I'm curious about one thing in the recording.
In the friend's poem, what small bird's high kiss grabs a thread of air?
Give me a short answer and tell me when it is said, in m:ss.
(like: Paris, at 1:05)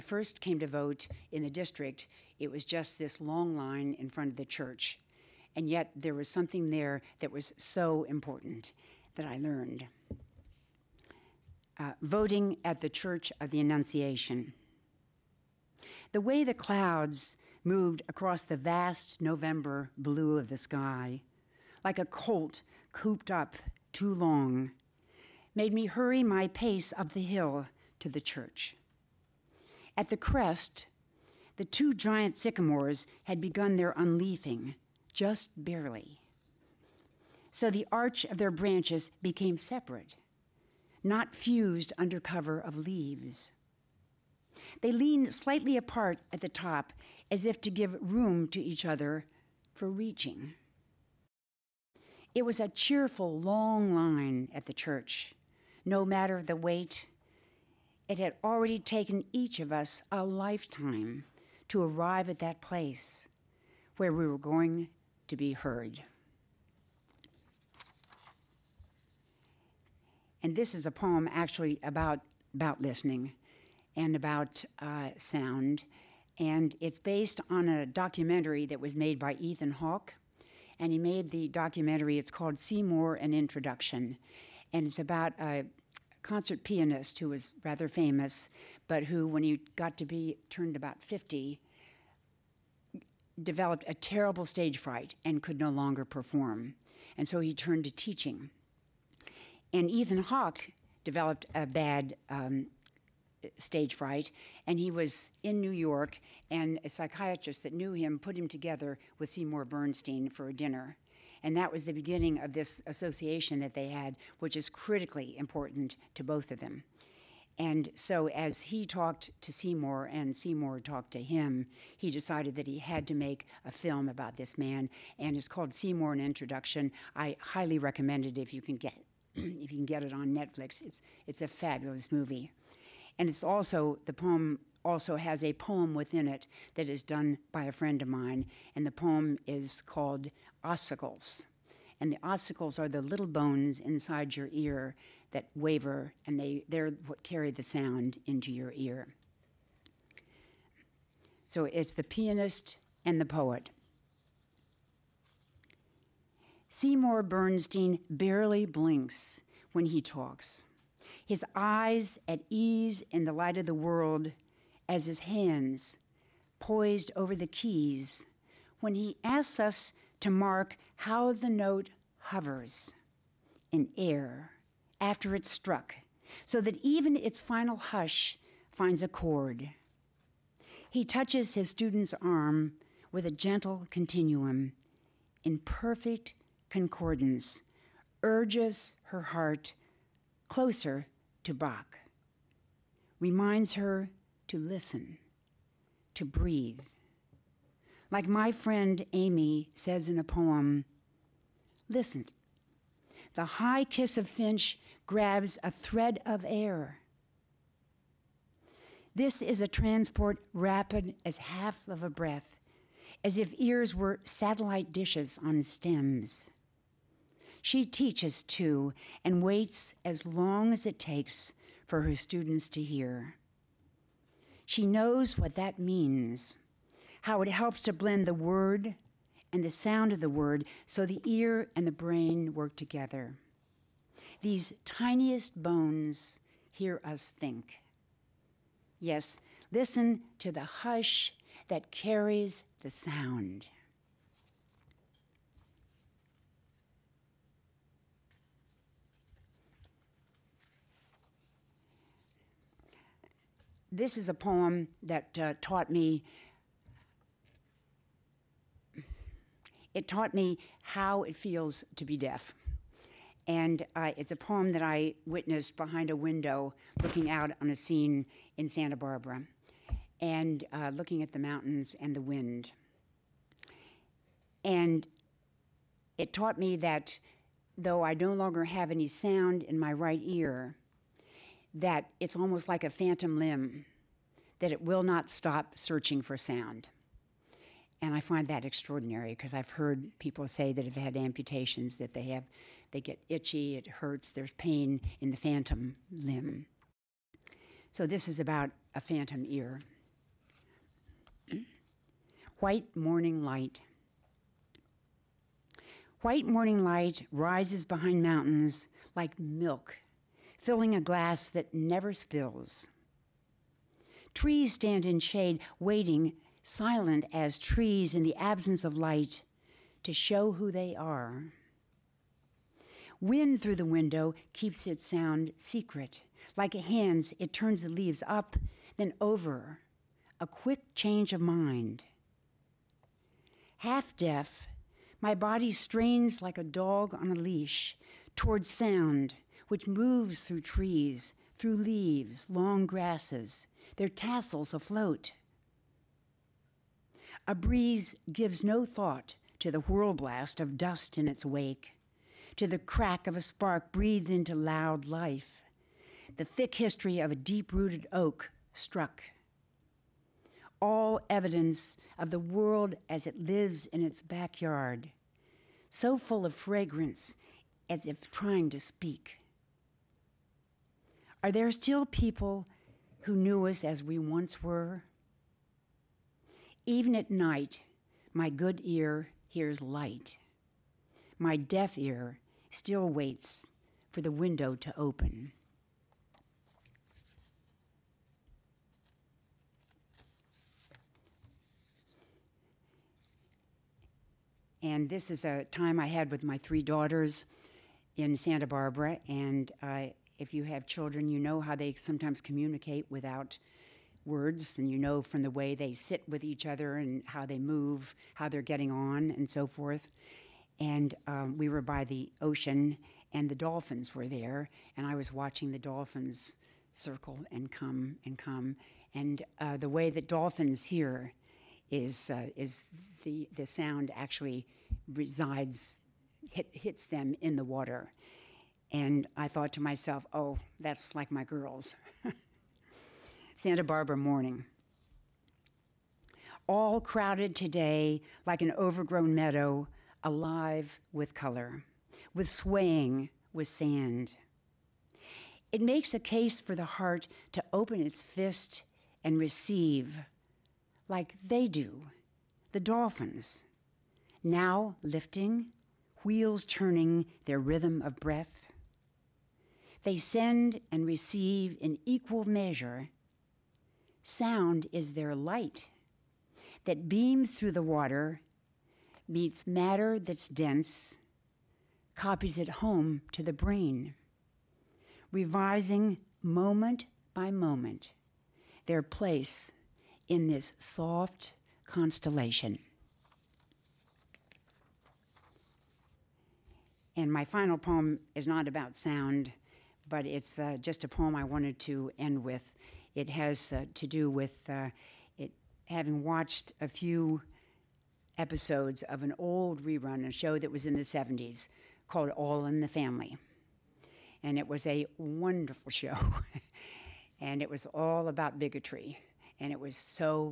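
Finch, at 3:24.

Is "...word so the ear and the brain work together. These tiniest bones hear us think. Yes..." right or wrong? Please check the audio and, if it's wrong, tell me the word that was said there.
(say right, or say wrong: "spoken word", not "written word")
right.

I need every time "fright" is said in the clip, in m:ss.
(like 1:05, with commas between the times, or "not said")
1:34, 1:43.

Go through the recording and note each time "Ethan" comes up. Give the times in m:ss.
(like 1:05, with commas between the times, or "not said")
1:19, 1:39.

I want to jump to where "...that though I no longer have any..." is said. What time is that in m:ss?
4:36.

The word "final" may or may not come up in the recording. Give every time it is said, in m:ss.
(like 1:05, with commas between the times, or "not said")
2:57, 8:07.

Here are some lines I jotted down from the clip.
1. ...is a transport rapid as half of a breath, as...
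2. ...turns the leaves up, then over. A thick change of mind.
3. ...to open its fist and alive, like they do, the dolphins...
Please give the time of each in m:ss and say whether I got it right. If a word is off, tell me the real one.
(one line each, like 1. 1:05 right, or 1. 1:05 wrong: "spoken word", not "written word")
1. 3:29 right
2. 5:27 wrong: "quick", not "thick"
3. 7:27 wrong: "receive", not "alive".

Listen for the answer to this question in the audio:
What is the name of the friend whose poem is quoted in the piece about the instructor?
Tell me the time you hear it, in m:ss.
3:19.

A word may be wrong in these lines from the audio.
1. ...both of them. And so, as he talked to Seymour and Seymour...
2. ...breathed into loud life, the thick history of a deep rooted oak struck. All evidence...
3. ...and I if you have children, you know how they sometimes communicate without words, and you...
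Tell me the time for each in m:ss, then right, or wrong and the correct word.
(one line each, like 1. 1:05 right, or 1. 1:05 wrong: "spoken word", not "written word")
1. 1:56 right
2. 5:53 right
3. 6:39 right.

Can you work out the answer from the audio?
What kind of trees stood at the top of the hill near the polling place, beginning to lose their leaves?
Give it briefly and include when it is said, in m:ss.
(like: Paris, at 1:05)
sycamores, at 0:32.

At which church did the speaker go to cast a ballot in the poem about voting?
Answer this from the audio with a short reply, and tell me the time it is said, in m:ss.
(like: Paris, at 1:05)
Church of the Annunciation, at 0:12.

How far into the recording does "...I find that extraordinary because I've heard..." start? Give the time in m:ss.
4:48.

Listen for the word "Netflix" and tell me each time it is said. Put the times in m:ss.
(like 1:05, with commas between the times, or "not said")
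2:10.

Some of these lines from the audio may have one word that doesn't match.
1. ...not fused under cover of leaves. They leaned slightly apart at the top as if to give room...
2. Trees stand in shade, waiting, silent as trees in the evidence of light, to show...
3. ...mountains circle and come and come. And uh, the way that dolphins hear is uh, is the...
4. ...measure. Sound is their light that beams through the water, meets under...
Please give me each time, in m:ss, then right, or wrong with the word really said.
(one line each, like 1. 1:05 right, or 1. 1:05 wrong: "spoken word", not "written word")
1. 0:41 right
2. 5:14 wrong: "absence", not "evidence"
3. 6:55 wrong: "dolphins", not "mountains"
4. 7:42 wrong: "matter", not "under".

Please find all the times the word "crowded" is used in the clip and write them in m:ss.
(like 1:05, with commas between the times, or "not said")
7:17.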